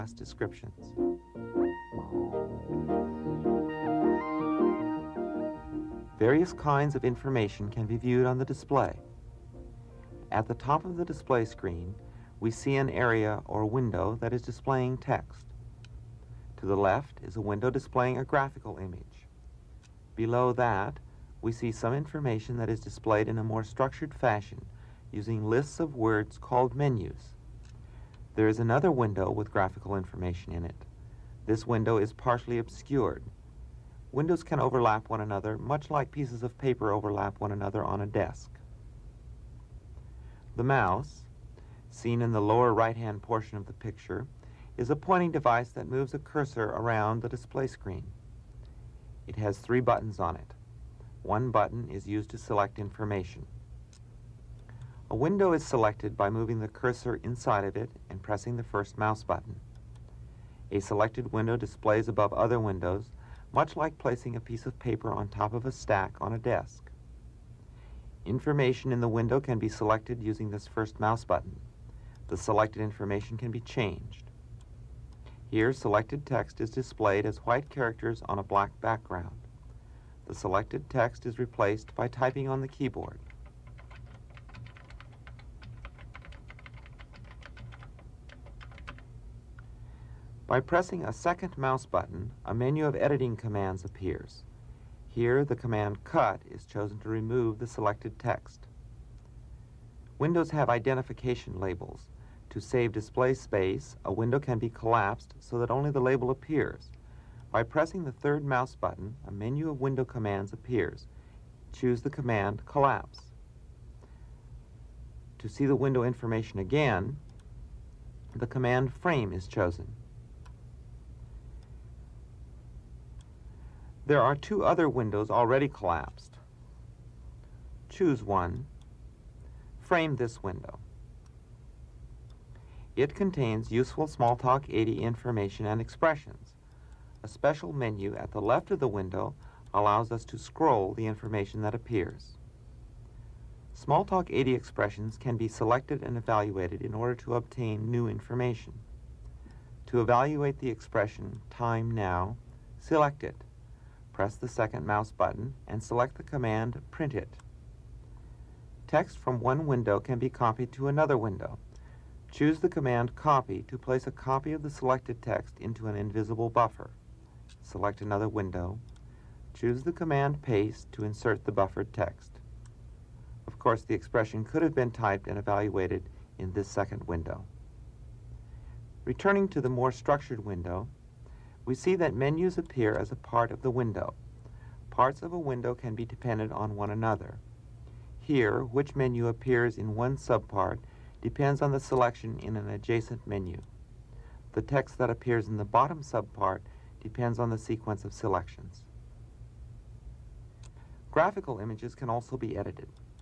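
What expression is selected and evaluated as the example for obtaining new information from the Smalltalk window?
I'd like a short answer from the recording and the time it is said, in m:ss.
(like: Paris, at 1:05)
time now, at 2:31.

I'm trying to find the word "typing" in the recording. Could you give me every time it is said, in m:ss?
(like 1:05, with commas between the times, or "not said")
1:22.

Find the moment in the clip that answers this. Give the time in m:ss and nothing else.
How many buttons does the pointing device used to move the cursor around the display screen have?
0:49.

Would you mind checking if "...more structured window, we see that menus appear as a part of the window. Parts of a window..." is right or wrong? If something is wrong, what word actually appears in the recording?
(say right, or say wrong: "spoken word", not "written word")
right.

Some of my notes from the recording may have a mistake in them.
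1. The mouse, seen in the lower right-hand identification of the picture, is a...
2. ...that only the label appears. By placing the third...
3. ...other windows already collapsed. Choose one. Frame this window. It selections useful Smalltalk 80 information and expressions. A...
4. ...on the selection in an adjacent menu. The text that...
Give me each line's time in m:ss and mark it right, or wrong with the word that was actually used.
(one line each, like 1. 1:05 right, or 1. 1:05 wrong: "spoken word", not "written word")
1. 0:40 wrong: "portion", not "identification"
2. 1:45 wrong: "pressing", not "placing"
3. 2:04 wrong: "contains", not "selections"
4. 3:11 right.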